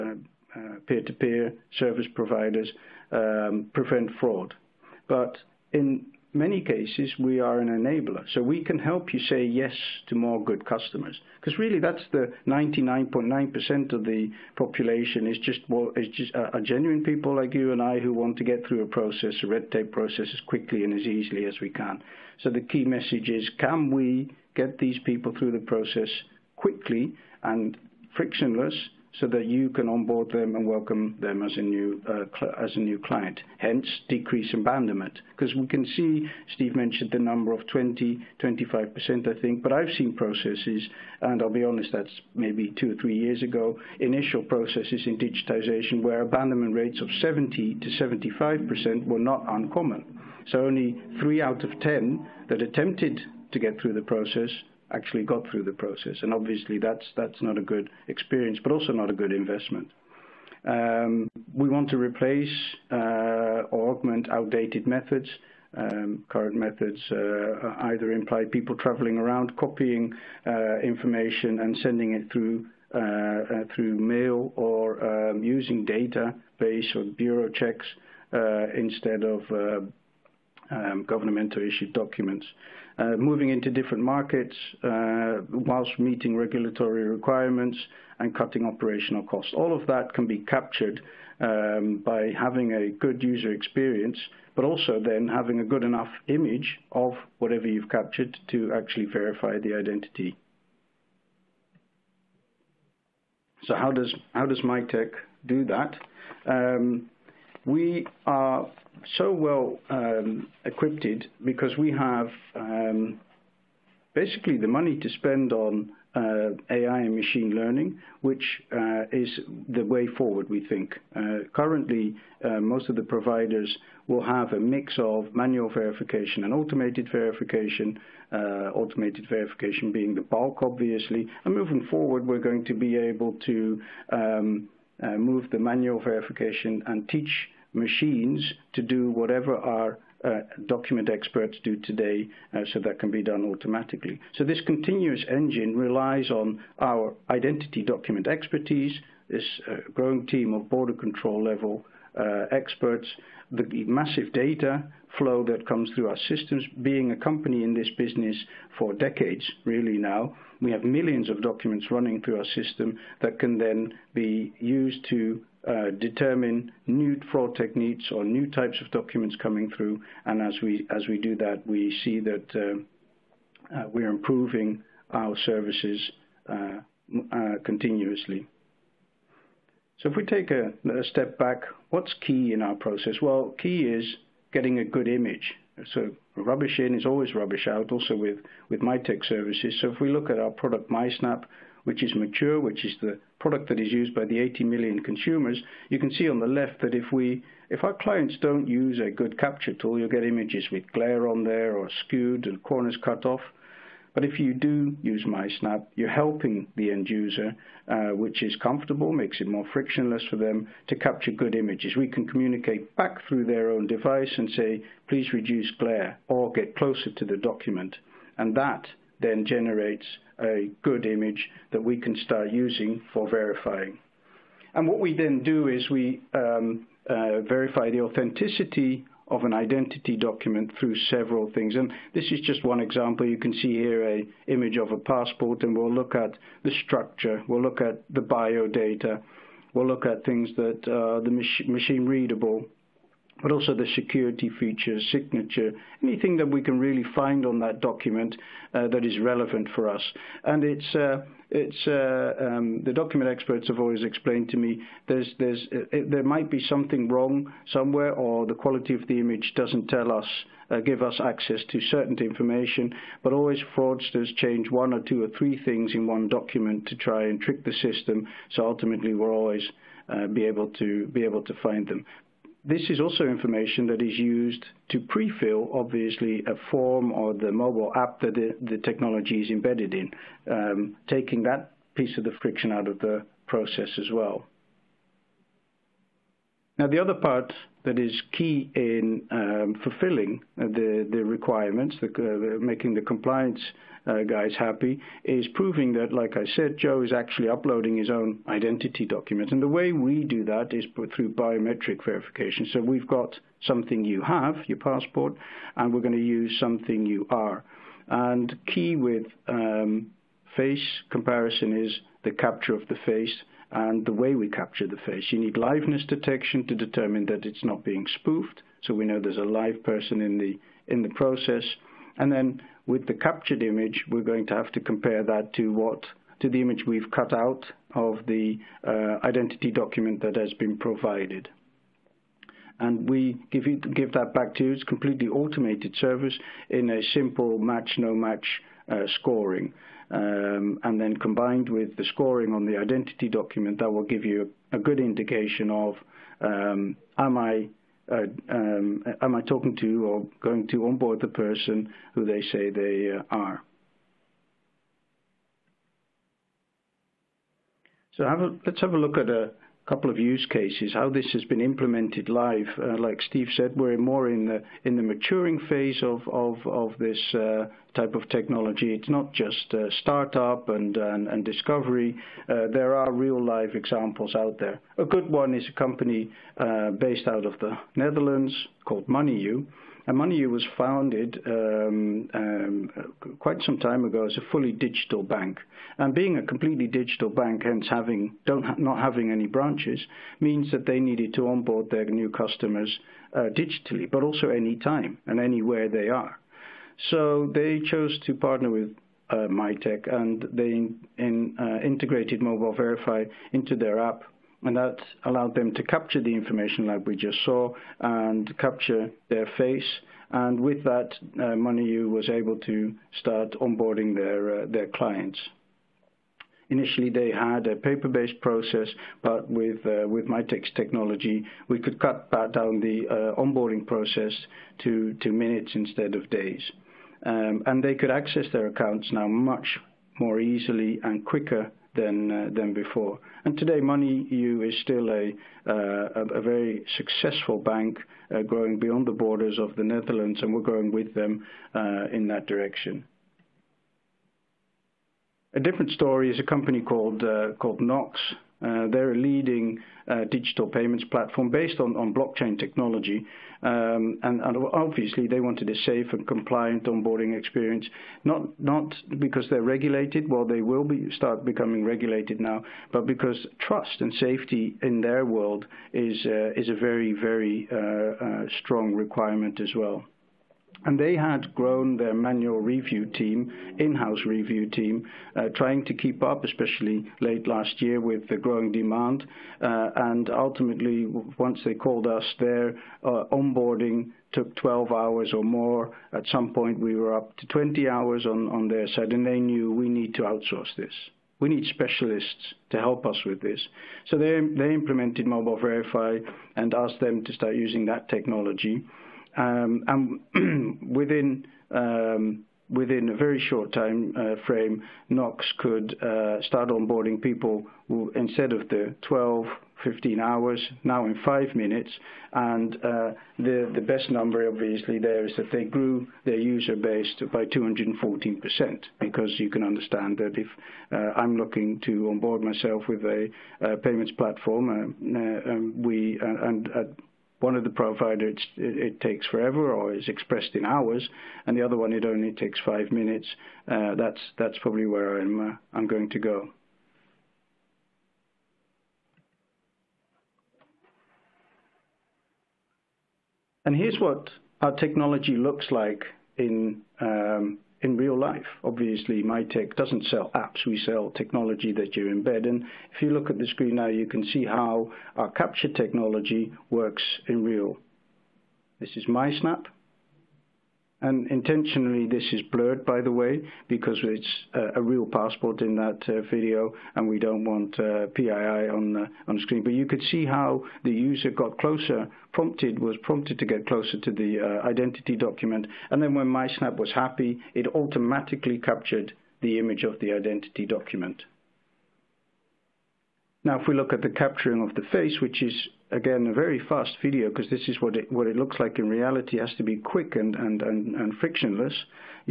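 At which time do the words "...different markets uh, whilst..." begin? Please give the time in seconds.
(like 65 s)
83 s.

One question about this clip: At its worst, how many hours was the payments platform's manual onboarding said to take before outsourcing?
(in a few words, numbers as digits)
20 hours.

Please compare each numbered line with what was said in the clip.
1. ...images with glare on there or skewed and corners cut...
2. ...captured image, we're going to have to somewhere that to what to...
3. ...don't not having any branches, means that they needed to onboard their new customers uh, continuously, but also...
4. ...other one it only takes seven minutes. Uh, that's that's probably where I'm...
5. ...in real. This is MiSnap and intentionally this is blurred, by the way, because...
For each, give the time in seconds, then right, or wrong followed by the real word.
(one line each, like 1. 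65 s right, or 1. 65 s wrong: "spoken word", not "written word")
1. 200 s right
2. 323 s wrong: "compare", not "somewhere"
3. 388 s wrong: "digitally", not "continuously"
4. 531 s wrong: "five", not "seven"
5. 557 s right.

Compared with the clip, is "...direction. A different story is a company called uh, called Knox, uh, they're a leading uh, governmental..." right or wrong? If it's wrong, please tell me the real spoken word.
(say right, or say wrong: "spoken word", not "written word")
wrong: "digital", not "governmental".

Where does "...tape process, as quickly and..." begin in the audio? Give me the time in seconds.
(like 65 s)
19 s.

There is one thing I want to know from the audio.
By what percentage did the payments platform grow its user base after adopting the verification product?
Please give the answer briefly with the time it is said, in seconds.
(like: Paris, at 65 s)
214%, at 517 s.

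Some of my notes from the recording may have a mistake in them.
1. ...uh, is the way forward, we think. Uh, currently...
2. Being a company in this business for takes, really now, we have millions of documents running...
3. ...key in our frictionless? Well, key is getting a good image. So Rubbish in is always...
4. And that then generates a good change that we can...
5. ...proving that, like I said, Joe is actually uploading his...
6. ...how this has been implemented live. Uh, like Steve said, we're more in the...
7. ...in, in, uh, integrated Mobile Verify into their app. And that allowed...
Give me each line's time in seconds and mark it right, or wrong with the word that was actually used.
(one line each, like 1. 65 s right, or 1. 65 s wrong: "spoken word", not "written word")
1. 118 s right
2. 156 s wrong: "decades", not "takes"
3. 182 s wrong: "process", not "frictionless"
4. 218 s wrong: "image", not "change"
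5. 295 s right
6. 360 s right
7. 400 s right.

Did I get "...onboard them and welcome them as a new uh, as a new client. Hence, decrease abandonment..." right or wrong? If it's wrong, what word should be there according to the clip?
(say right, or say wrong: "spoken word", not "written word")
right.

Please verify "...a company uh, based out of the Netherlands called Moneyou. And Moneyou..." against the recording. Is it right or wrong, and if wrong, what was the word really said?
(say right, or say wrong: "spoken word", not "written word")
right.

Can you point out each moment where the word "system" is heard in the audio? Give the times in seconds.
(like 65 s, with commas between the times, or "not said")
156 s, 162 s, 267 s.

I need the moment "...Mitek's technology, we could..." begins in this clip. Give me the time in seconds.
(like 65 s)
420 s.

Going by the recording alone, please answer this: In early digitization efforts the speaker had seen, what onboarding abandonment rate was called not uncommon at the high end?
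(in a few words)
75 percent.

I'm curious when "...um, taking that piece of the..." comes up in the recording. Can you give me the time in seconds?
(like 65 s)
280 s.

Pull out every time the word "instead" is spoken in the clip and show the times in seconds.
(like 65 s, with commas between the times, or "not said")
78 s, 425 s, 508 s.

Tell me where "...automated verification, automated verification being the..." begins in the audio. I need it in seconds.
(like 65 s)
126 s.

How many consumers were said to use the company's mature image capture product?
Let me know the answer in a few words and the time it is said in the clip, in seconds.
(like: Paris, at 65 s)
80 million, at 194 s.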